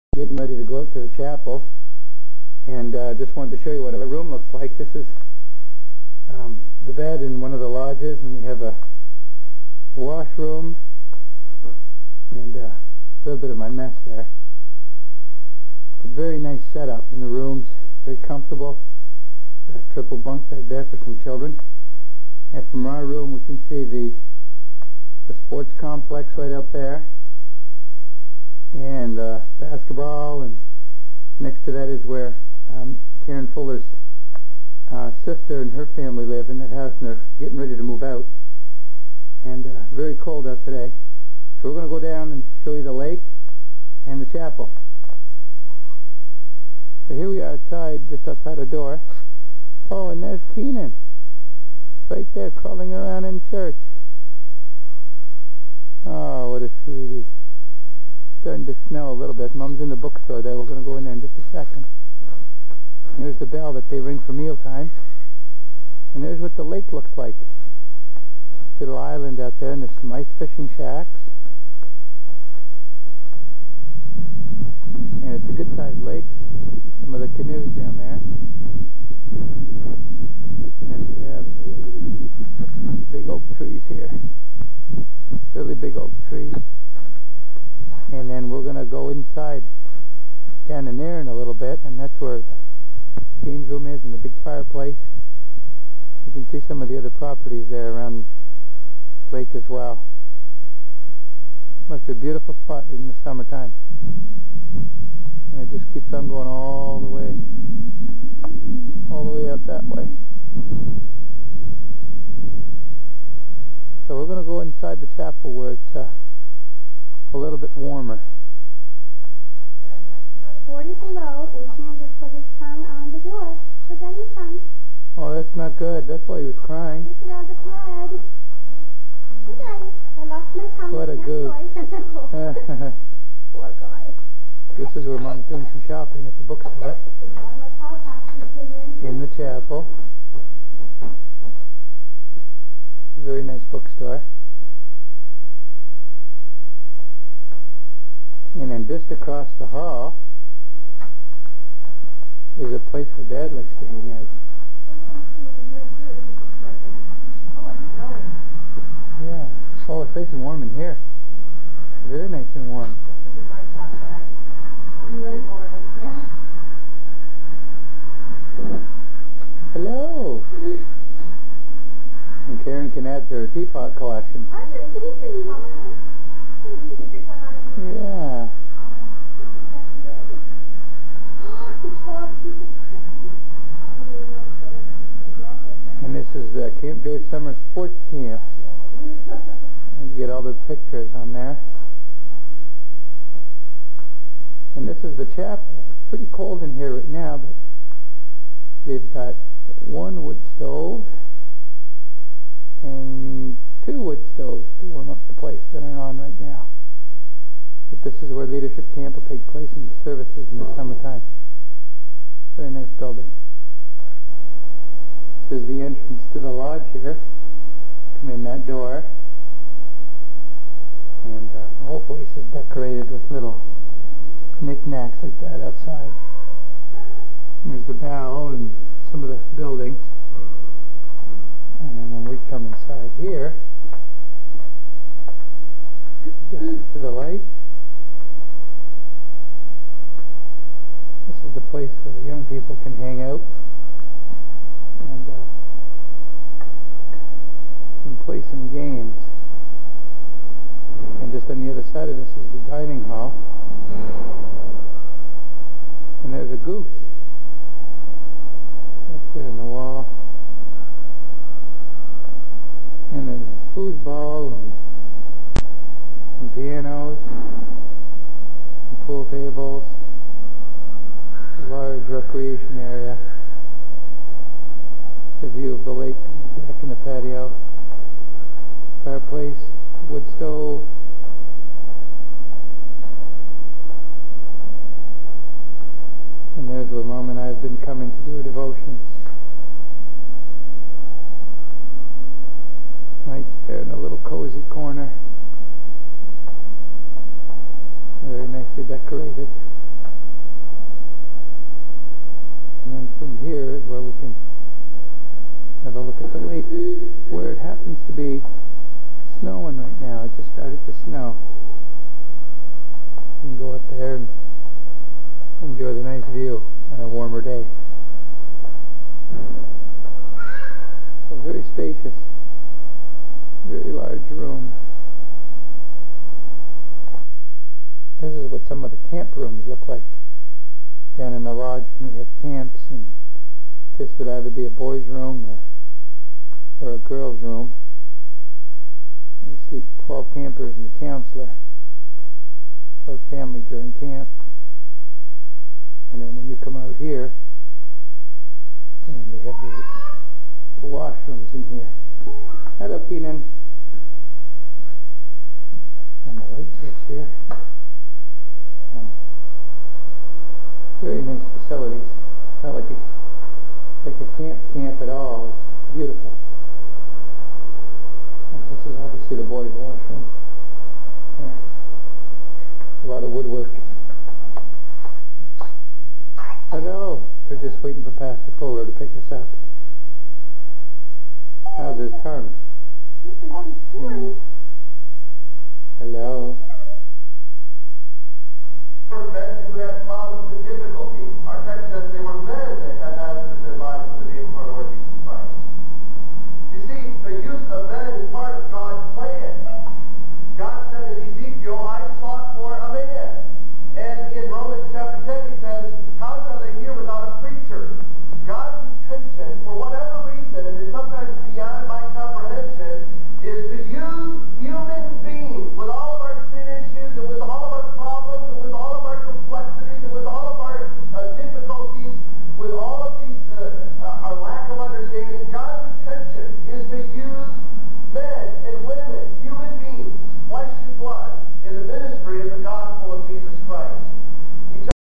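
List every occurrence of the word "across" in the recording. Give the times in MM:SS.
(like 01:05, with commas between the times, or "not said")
02:29.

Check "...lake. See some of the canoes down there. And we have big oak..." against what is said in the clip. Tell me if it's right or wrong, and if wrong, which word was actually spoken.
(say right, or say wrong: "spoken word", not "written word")
right.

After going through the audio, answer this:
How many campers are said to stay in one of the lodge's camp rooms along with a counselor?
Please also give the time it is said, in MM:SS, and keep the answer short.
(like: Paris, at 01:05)
12, at 05:40.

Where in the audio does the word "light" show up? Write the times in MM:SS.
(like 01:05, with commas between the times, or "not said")
03:57, 05:56.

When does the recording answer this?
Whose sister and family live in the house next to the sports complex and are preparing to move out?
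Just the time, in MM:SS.
00:33.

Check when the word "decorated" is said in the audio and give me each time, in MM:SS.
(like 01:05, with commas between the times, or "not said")
03:42, 04:58.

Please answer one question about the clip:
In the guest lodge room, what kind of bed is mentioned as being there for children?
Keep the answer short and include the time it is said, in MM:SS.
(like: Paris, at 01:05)
Triple bunk bed, at 00:19.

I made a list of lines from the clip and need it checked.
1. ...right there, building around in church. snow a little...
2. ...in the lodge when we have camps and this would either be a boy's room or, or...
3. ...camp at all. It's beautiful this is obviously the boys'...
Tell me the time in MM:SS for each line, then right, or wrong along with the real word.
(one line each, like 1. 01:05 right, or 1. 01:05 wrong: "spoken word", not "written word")
1. 00:52 wrong: "crawling", not "building"
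2. 05:31 right
3. 06:04 right.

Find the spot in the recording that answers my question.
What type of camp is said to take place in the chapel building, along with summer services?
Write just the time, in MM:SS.
03:28.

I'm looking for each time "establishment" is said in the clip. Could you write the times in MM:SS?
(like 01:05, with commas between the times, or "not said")
not said.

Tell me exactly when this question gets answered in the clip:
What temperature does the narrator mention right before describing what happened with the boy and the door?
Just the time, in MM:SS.
02:00.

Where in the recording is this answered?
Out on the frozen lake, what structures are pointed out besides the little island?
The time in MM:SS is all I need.
01:10.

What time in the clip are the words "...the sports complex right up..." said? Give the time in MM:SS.
00:25.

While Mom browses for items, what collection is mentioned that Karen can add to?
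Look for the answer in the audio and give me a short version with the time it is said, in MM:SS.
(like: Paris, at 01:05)
Teapot collection, at 02:53.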